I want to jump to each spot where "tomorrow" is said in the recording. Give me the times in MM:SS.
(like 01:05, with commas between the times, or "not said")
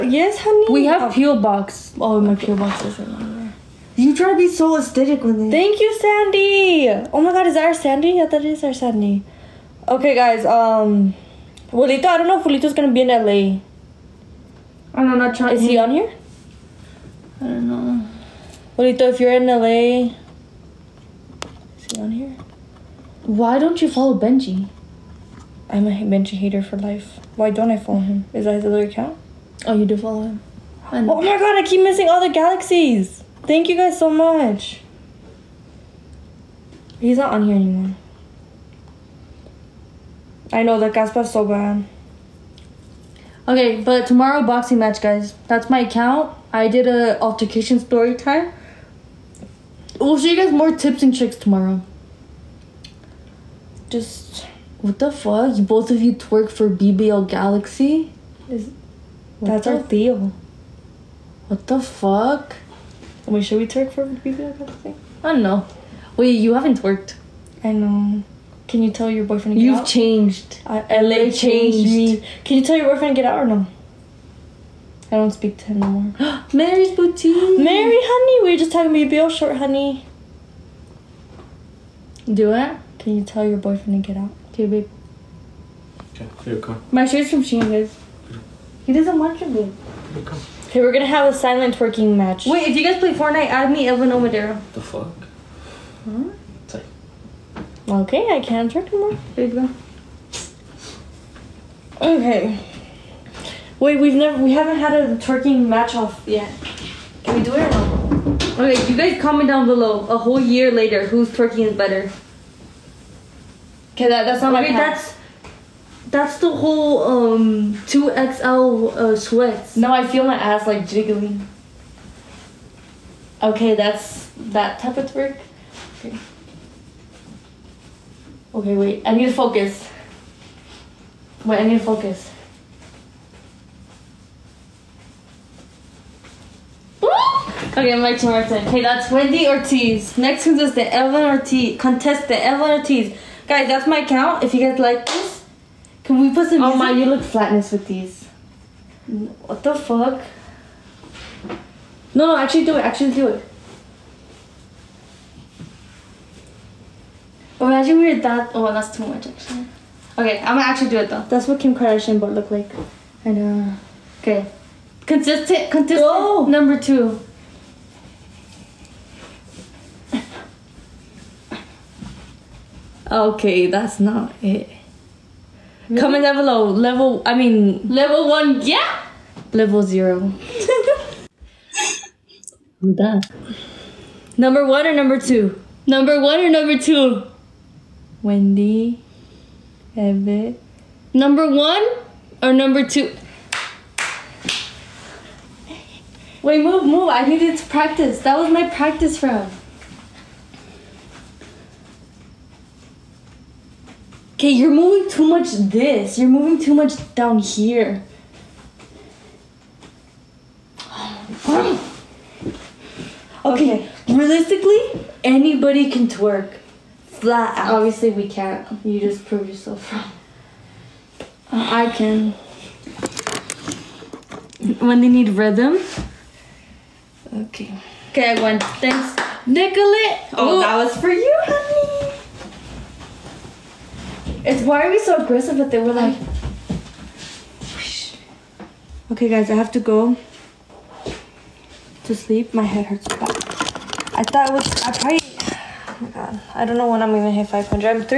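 00:44, 00:51.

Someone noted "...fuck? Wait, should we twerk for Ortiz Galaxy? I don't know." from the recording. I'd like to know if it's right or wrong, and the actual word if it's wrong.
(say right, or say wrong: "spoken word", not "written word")
wrong: "BBL", not "Ortiz".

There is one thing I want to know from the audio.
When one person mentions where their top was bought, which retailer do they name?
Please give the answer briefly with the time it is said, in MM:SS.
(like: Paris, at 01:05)
Shein, at 01:27.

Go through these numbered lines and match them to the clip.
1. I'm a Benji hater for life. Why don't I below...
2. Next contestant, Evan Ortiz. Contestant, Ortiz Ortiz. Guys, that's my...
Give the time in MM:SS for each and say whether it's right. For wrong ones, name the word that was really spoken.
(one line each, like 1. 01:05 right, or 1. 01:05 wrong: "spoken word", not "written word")
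1. 00:25 wrong: "follow", not "below"
2. 02:20 wrong: "Evan", not "Ortiz".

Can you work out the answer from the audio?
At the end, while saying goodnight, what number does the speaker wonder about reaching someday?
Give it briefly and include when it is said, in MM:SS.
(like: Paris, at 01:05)
500, at 04:07.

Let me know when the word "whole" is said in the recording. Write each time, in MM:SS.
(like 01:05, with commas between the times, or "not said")
01:50, 01:56.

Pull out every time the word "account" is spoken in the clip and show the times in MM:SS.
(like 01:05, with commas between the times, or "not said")
00:28, 00:45.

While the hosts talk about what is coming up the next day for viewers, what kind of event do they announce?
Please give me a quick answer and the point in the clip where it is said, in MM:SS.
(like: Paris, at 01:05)
Boxing match, at 00:44.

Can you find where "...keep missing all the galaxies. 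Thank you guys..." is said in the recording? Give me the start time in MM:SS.
00:31.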